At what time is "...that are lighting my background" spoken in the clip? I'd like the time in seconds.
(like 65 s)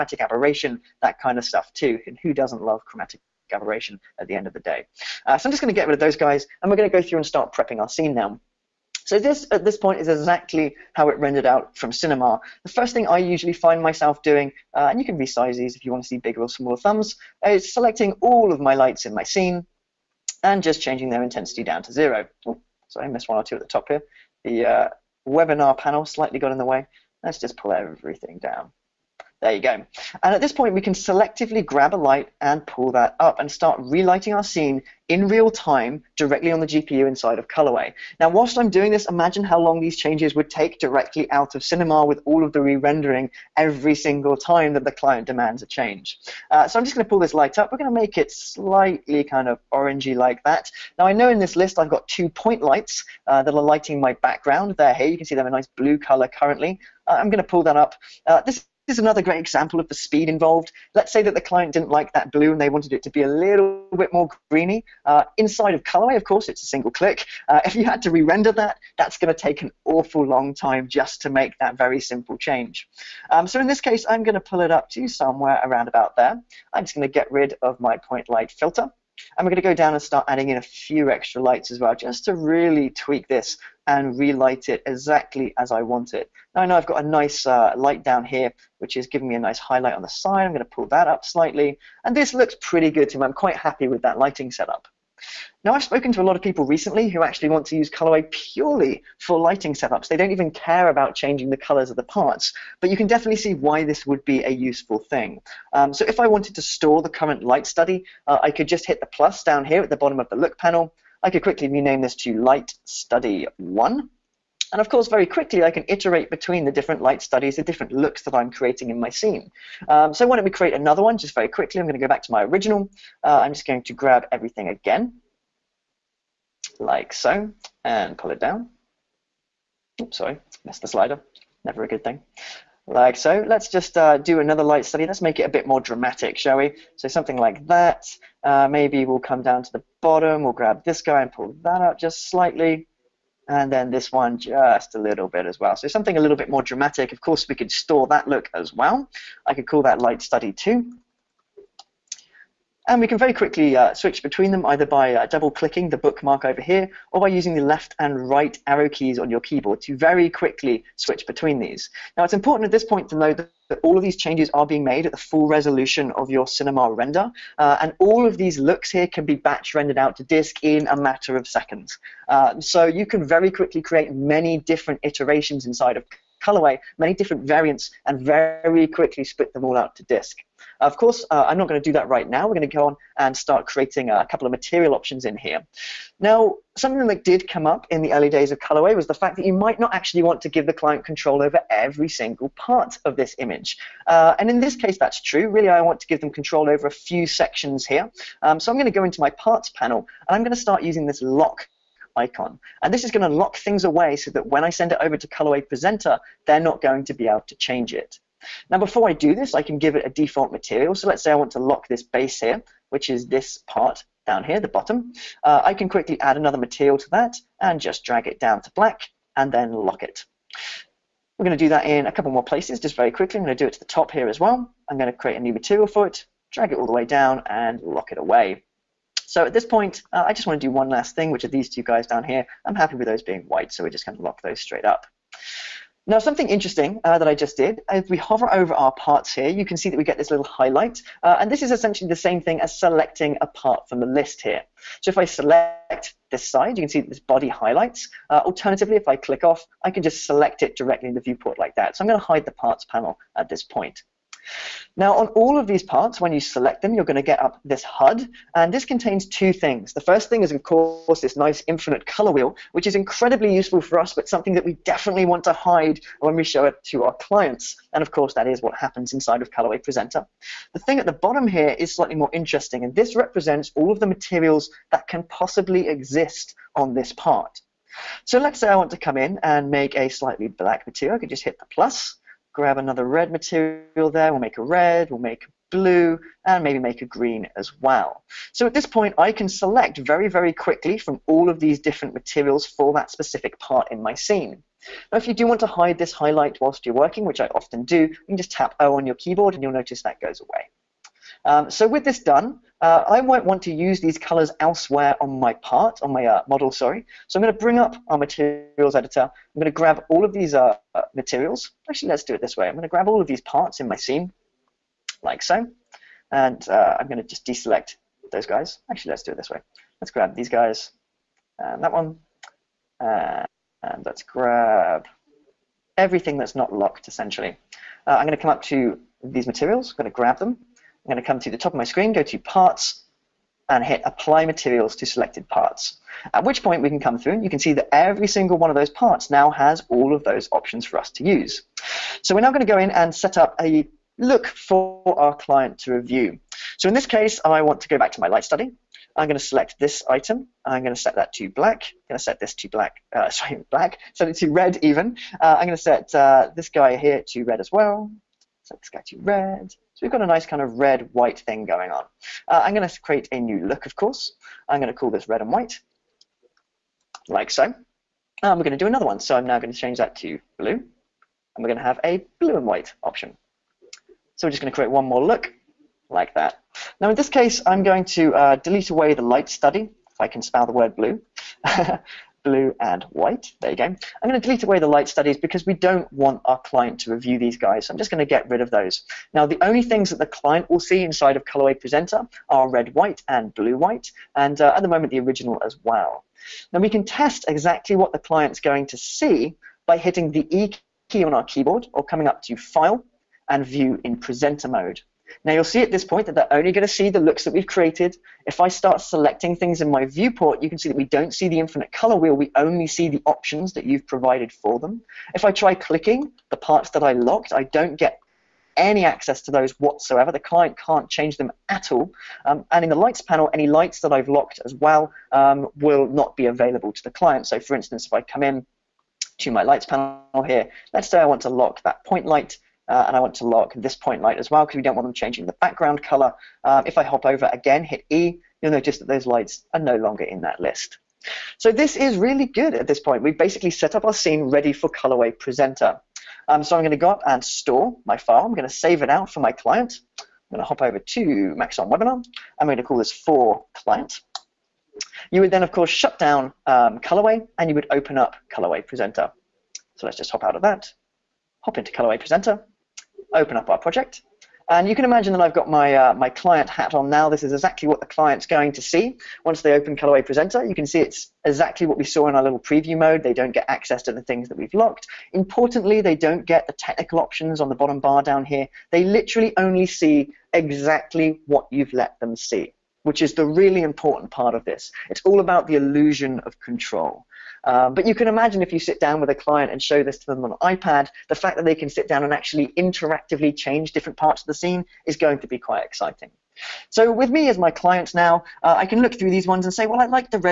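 53 s.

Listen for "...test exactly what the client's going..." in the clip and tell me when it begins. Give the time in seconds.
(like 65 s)
397 s.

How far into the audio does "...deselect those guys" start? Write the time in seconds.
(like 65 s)
317 s.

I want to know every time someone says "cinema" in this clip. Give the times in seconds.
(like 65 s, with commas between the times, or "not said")
11 s, 41 s, 166 s.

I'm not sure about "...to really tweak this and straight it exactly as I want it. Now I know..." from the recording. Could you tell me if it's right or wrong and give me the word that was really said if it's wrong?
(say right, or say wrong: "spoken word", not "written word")
wrong: "relight", not "straight".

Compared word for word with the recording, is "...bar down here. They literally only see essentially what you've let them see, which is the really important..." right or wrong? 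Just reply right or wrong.
wrong.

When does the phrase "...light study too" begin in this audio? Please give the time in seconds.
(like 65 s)
150 s.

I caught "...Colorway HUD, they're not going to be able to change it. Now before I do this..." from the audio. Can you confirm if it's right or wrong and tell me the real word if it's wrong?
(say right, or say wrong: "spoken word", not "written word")
wrong: "Presenter", not "HUD".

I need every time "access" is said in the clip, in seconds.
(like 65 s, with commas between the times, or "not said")
419 s, 473 s.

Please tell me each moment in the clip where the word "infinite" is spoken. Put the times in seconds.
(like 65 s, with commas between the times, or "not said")
261 s, 411 s.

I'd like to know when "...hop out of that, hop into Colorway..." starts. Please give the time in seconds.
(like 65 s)
460 s.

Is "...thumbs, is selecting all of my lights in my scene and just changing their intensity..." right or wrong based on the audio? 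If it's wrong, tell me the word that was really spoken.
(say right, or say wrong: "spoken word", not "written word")
right.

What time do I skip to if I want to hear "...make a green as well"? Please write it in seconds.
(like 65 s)
286 s.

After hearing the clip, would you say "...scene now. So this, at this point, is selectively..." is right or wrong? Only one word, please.
wrong.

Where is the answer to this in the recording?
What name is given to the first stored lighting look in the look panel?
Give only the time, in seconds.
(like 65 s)
112 s.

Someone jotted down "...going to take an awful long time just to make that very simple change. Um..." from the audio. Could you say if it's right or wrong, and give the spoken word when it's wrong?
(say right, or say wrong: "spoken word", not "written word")
right.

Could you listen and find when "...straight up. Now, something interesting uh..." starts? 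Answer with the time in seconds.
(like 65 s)
234 s.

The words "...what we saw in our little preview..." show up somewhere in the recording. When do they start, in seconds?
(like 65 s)
471 s.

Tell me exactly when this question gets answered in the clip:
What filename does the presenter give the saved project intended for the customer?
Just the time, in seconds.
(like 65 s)
453 s.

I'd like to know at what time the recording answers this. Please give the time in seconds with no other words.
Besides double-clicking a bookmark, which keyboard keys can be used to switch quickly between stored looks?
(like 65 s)
157 s.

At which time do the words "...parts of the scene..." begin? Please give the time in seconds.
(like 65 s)
494 s.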